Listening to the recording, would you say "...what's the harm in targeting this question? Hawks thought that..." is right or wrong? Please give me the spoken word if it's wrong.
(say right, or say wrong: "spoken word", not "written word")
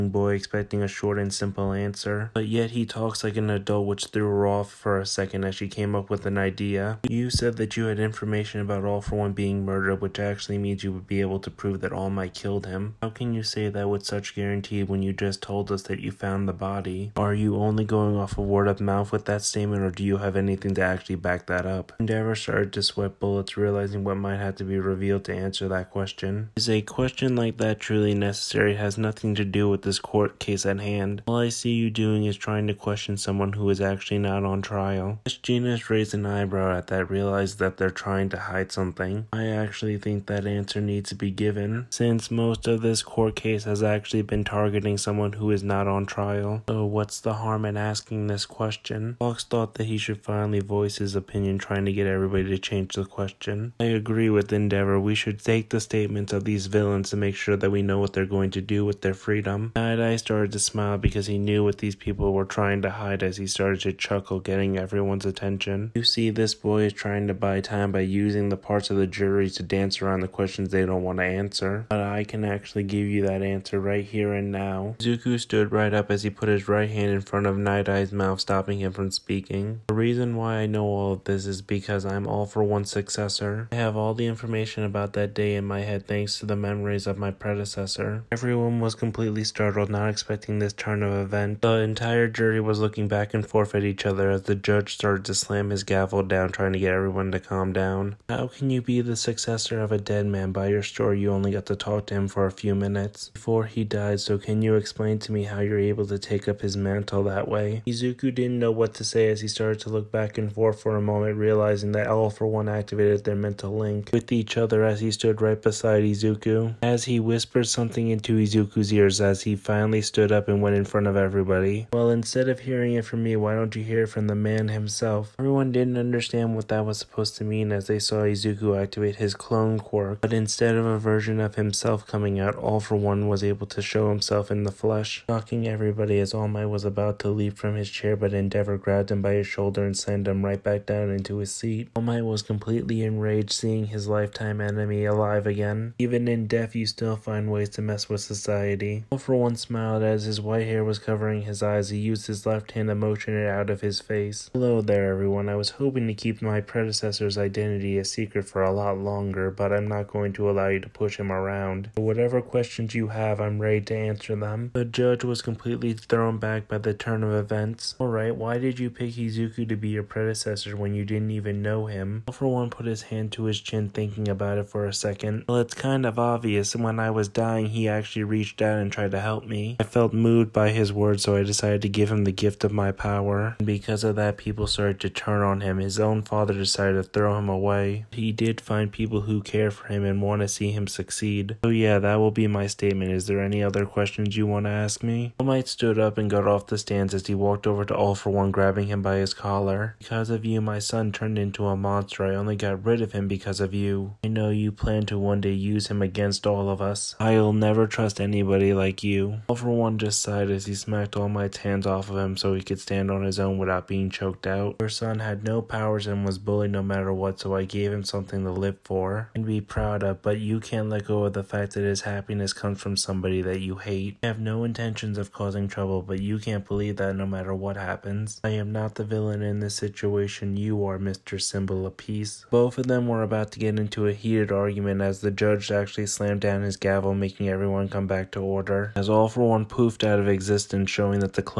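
wrong: "asking", not "targeting".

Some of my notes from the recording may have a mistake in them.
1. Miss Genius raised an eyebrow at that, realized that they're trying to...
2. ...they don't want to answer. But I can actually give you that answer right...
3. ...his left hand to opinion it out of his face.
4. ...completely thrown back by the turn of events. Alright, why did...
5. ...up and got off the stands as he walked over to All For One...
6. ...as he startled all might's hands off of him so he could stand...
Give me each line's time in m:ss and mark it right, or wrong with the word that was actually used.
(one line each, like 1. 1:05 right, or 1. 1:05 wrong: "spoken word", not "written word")
1. 0:35 right
2. 1:10 right
3. 2:32 wrong: "motion", not "opinion"
4. 2:45 right
5. 3:15 right
6. 3:30 wrong: "smacked", not "startled".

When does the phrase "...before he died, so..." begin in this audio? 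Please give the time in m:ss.
1:43.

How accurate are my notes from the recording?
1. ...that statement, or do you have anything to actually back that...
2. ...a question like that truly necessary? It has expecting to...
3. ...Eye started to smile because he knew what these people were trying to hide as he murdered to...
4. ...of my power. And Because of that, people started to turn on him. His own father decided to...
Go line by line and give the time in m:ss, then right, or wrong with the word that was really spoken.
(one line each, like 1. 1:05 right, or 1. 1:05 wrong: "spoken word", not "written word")
1. 0:19 right
2. 0:26 wrong: "nothing", not "expecting"
3. 0:59 wrong: "started", not "murdered"
4. 3:02 right.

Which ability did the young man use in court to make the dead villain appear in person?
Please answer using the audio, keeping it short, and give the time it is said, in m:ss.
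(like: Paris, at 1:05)
Clone quirk, at 2:09.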